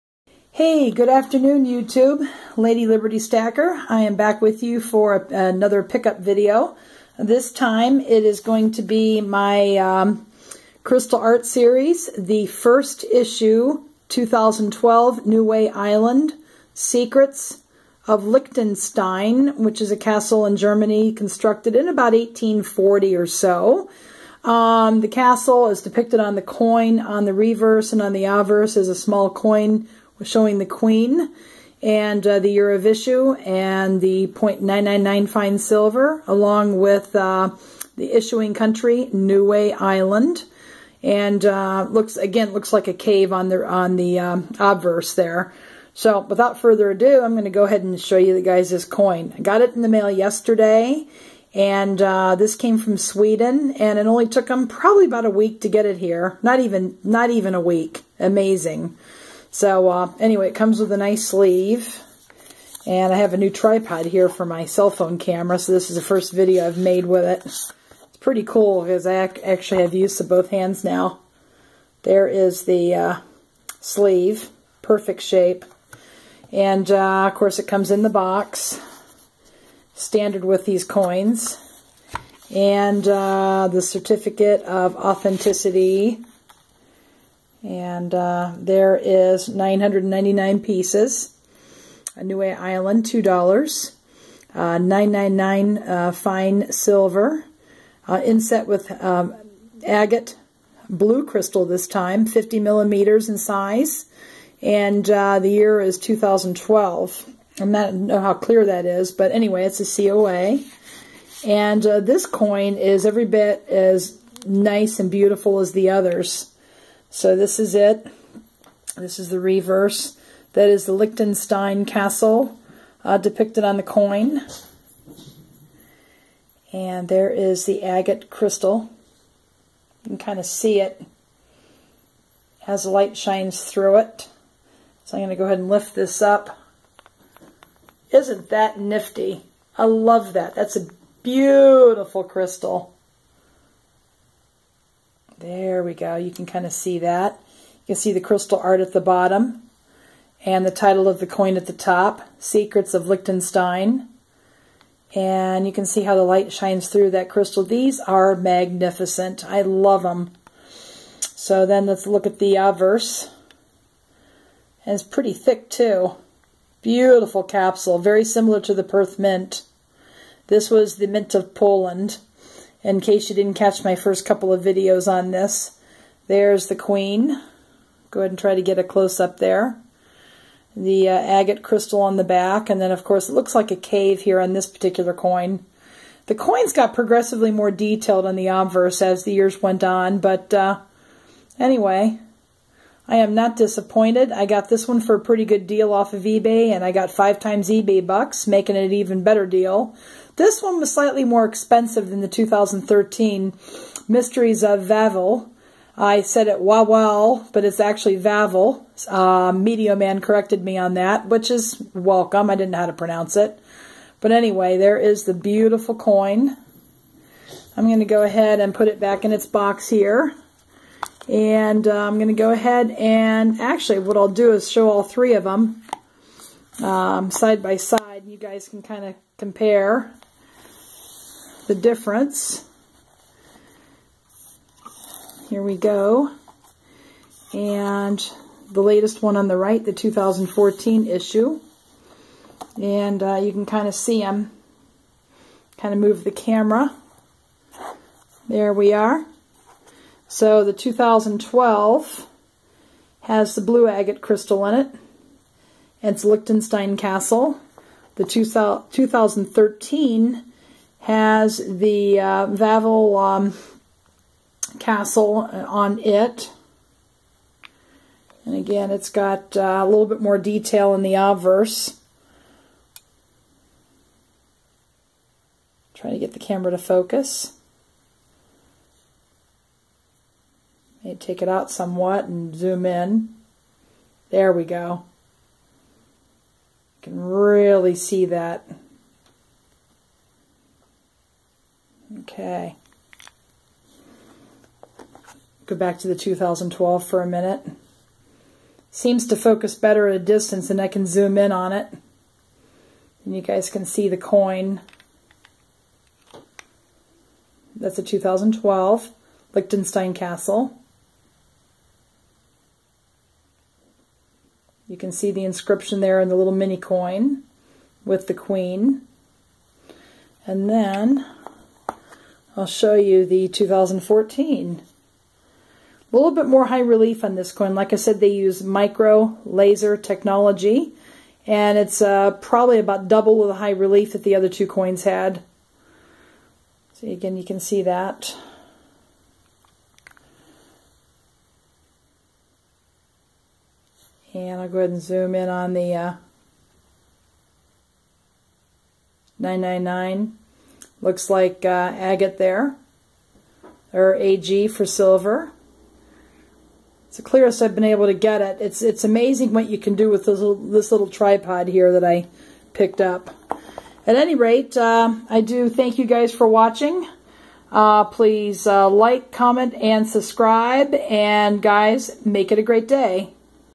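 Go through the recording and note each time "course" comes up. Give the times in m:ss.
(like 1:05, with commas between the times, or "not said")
1:17, 3:03.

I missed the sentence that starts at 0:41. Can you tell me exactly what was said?
And uh, looks again looks like a cave on the on the um, obverse there.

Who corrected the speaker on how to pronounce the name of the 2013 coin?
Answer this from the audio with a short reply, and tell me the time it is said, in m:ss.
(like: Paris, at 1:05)
Media Man, at 3:29.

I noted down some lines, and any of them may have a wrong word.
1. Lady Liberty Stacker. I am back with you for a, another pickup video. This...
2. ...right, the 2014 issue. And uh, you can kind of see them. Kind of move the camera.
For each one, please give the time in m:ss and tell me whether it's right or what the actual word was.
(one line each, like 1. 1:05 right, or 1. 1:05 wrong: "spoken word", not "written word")
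1. 0:02 right
2. 3:59 right.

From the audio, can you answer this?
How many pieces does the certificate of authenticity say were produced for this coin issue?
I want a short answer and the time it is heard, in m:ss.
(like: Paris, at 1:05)
999, at 1:29.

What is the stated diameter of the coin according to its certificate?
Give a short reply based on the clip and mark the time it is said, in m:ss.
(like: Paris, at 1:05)
50 millimeters, at 1:42.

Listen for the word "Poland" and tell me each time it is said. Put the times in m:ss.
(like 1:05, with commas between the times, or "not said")
2:51.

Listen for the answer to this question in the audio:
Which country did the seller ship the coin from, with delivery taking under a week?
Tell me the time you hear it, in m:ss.
0:52.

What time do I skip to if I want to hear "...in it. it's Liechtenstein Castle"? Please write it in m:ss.
4:14.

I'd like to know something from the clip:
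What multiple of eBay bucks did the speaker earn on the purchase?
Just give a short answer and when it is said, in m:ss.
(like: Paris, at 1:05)
5, at 3:17.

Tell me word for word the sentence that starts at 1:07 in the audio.
It's pretty cool because I actually have use of both hands now.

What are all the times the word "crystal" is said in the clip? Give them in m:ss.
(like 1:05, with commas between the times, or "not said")
0:10, 1:41, 2:08, 2:22, 2:28, 2:37, 3:01, 4:14.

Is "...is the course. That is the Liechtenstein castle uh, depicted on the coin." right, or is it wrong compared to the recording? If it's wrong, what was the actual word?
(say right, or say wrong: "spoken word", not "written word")
wrong: "reverse", not "course".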